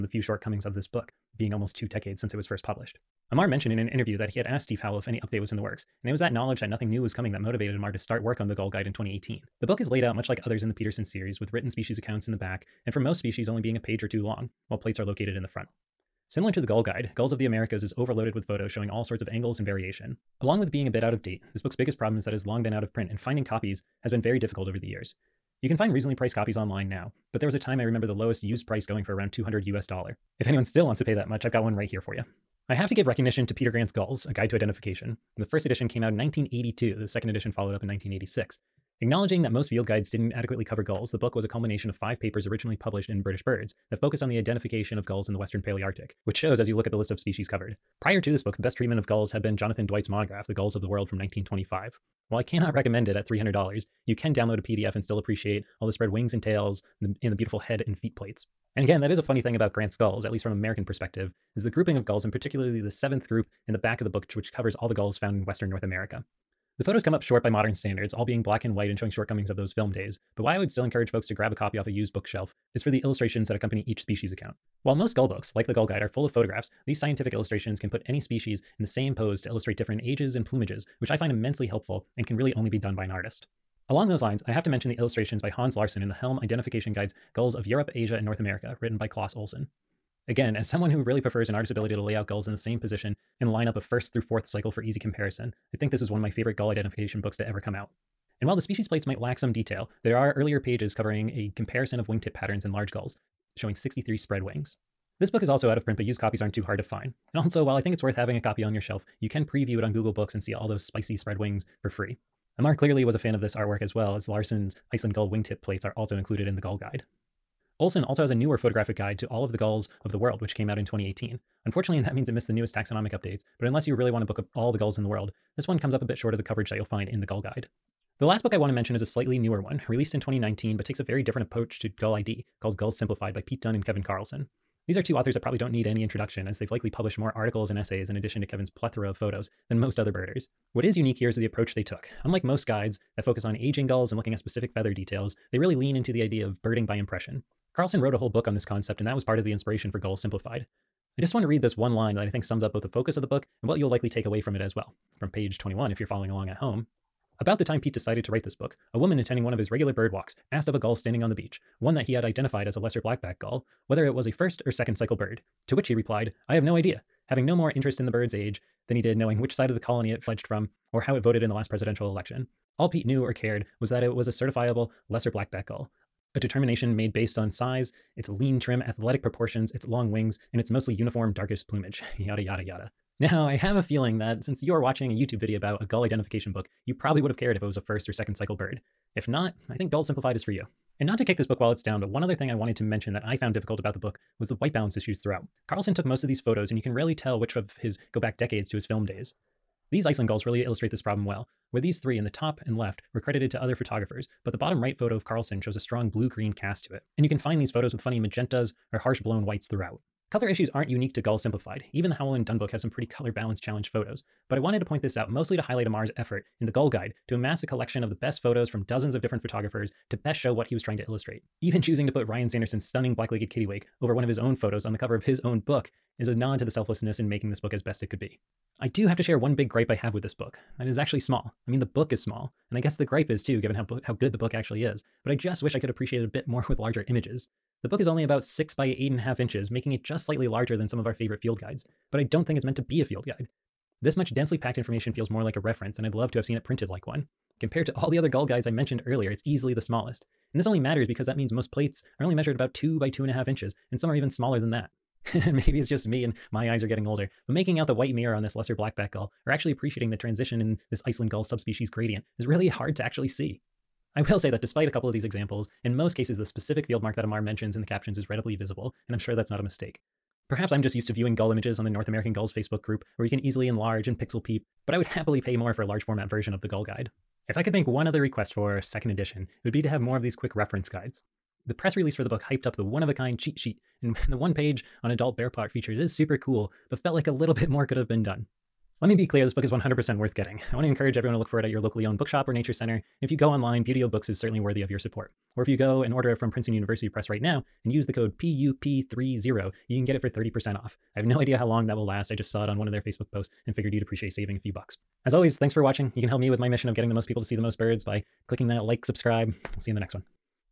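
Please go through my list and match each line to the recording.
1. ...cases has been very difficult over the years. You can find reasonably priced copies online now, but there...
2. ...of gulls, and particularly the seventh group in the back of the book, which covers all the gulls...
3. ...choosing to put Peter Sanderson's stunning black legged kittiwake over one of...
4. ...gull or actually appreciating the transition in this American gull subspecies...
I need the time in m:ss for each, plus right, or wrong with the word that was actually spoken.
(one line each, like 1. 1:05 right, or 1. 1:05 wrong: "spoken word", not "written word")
1. 0:23 wrong: "copies", not "cases"
2. 1:01 right
3. 3:41 wrong: "Ryan", not "Peter"
4. 4:19 wrong: "Iceland", not "American".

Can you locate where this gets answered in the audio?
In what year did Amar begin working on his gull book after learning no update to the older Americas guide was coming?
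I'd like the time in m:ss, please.
0:07.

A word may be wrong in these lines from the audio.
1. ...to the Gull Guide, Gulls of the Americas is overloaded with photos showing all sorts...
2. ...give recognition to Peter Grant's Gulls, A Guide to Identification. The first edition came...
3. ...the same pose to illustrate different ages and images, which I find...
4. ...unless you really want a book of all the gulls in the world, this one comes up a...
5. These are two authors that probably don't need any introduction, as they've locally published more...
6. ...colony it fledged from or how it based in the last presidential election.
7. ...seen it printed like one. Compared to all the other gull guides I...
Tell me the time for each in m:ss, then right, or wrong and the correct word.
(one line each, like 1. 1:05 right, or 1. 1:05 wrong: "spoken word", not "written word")
1. 0:16 right
2. 0:32 right
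3. 1:18 wrong: "plumages", not "images"
4. 2:03 right
5. 2:14 wrong: "likely", not "locally"
6. 2:49 wrong: "voted", not "based"
7. 4:06 right.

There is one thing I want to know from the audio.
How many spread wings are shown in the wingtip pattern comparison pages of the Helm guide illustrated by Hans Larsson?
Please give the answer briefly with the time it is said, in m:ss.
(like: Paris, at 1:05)
63, at 1:43.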